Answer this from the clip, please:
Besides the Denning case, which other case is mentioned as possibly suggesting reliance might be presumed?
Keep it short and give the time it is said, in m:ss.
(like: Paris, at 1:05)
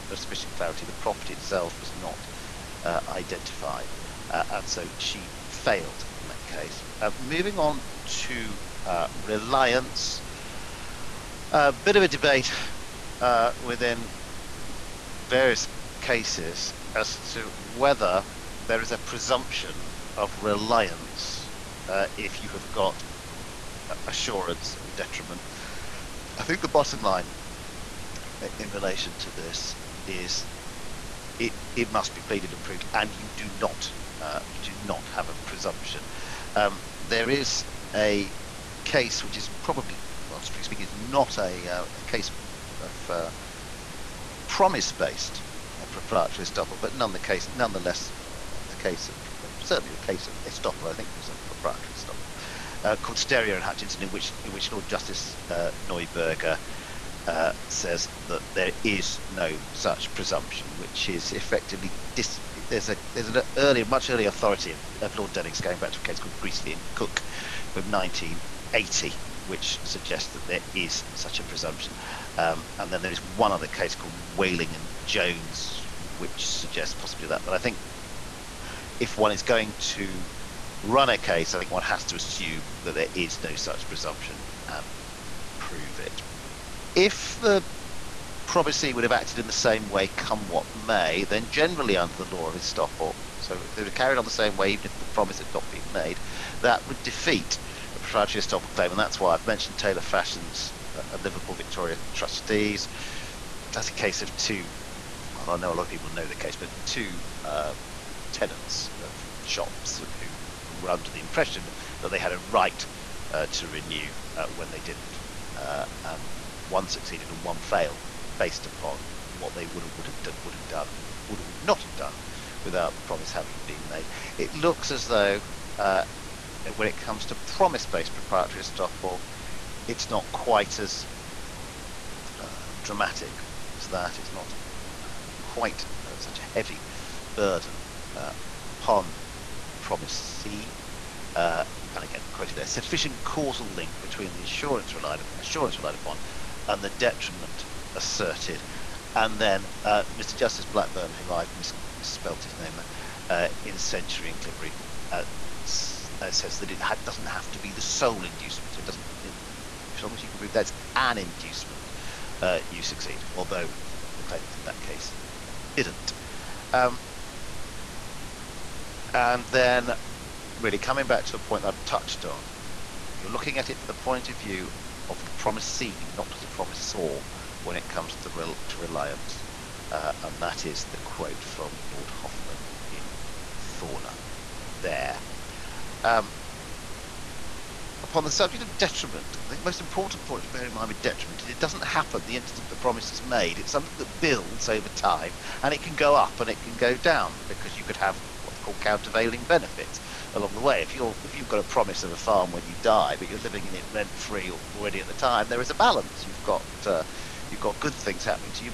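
Wayling and Jones, at 1:14.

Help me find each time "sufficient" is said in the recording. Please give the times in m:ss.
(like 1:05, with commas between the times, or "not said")
0:00, 2:22.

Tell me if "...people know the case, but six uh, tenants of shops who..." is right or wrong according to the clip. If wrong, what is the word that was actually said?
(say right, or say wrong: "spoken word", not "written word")
wrong: "two", not "six".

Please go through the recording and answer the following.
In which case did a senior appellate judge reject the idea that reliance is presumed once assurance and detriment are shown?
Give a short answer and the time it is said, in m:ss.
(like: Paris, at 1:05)
Steria and Hutchison, at 0:53.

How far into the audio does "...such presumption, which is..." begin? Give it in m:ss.
0:59.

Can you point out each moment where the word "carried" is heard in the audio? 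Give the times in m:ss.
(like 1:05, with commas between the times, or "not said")
1:33.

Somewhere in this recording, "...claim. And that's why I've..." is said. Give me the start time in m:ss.
1:38.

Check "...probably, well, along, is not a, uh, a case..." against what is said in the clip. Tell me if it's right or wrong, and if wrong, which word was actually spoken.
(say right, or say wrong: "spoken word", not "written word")
wrong: "speaking", not "along".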